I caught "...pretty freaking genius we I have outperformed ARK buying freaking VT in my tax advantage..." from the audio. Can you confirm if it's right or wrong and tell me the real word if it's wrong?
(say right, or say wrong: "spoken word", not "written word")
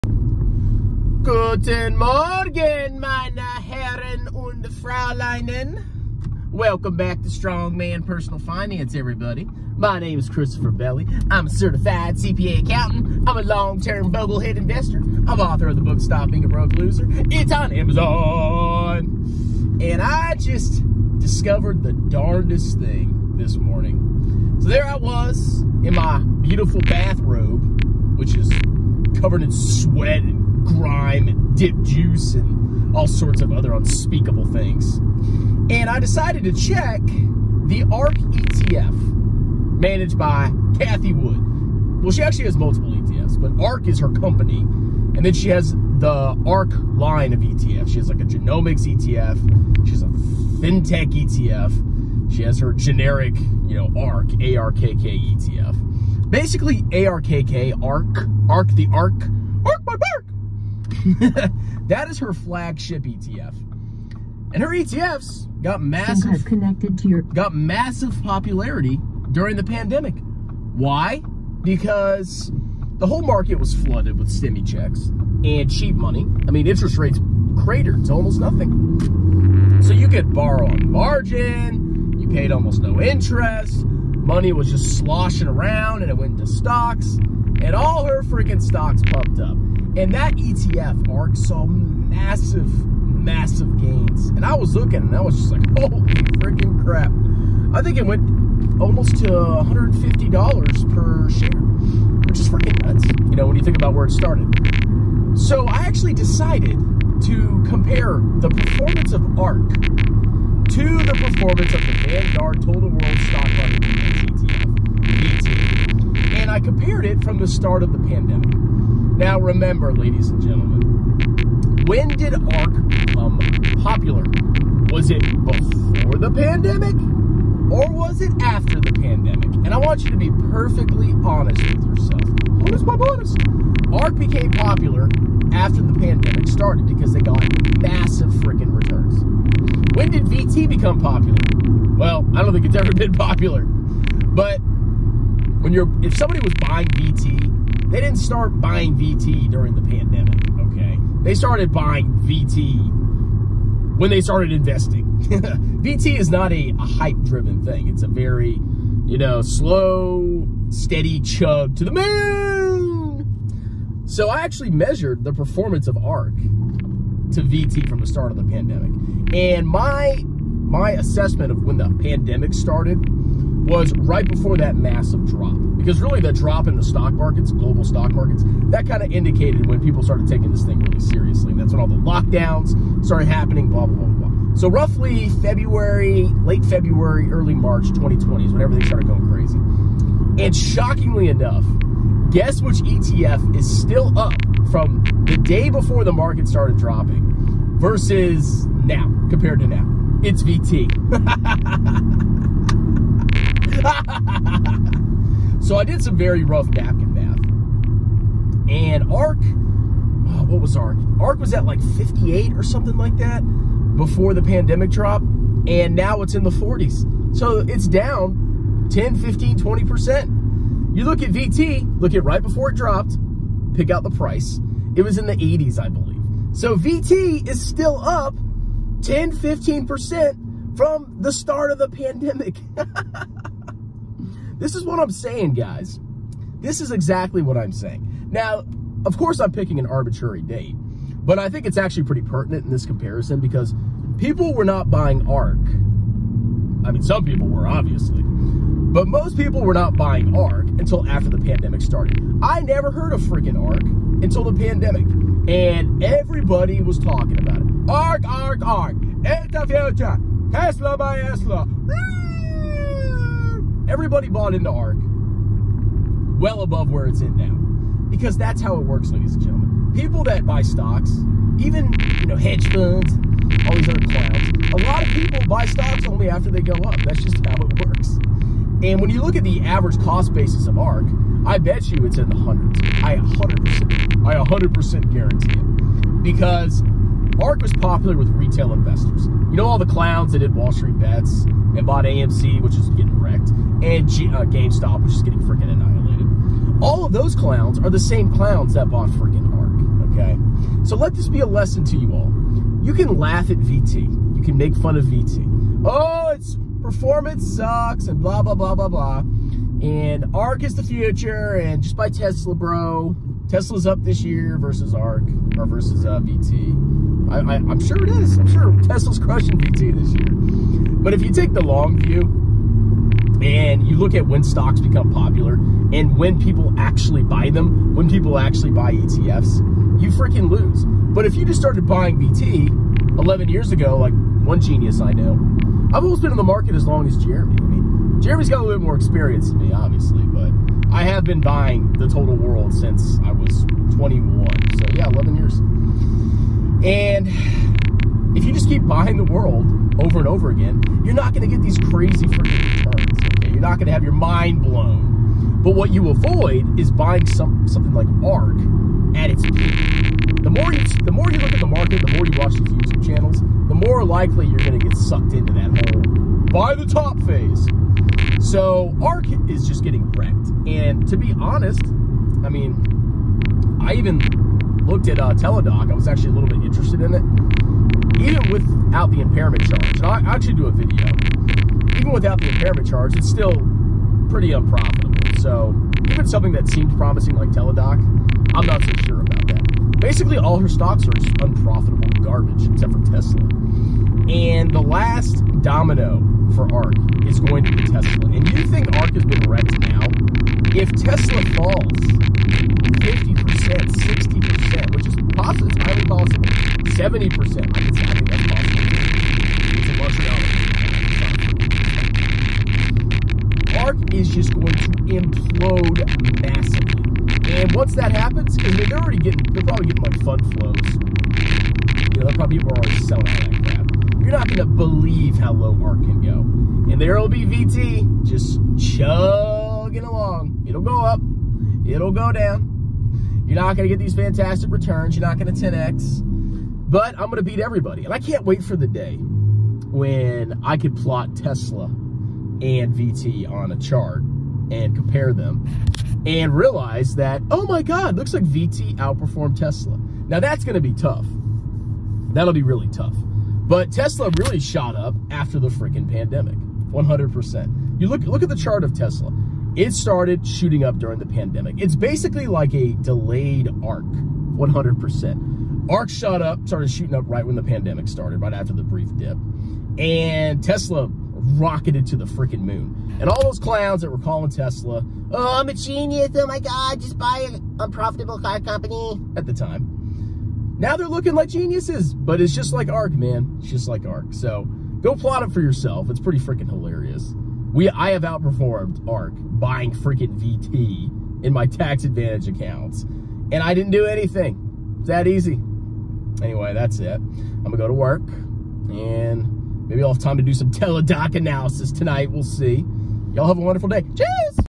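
wrong: "hilarious", not "genius".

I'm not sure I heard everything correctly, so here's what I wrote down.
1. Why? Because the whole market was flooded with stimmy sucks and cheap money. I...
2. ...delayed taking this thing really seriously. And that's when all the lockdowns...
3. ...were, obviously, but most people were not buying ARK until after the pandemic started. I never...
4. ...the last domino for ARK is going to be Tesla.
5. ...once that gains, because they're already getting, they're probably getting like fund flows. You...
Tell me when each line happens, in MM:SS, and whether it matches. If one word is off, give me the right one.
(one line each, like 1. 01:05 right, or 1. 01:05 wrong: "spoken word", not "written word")
1. 01:10 wrong: "checks", not "sucks"
2. 03:00 wrong: "started", not "delayed"
3. 04:07 right
4. 06:34 right
5. 06:57 wrong: "happens", not "gains".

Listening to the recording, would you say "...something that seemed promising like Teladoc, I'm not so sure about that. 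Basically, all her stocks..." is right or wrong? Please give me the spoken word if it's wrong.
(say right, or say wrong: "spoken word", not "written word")
right.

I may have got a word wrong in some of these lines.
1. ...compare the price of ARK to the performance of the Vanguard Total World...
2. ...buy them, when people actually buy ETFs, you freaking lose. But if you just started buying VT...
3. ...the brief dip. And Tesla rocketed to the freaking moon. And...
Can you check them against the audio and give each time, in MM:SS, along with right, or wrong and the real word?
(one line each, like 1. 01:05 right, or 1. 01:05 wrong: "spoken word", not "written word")
1. 01:47 wrong: "performance", not "price"
2. 05:27 right
3. 07:48 right.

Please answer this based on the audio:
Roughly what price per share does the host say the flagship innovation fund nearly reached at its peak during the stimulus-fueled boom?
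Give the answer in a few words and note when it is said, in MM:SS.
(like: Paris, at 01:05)
$150, at 01:39.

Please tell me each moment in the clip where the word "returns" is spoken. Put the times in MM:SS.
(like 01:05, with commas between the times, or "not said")
02:18, 05:52, 07:14.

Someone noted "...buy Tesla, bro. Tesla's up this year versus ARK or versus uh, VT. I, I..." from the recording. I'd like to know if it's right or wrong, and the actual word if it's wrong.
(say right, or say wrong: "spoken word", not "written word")
right.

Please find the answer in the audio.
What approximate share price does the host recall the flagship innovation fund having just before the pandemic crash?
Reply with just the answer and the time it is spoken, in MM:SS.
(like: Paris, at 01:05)
58, at 03:31.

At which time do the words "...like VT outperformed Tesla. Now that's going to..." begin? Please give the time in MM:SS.
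07:28.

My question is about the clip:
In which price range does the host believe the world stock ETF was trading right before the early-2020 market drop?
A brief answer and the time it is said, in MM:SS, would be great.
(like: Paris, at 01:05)
the 80s, at 03:45.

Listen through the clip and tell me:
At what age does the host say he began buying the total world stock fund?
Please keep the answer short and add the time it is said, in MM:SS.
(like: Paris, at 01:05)
21, at 05:43.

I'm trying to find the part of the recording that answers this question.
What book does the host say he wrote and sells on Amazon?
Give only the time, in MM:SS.
00:15.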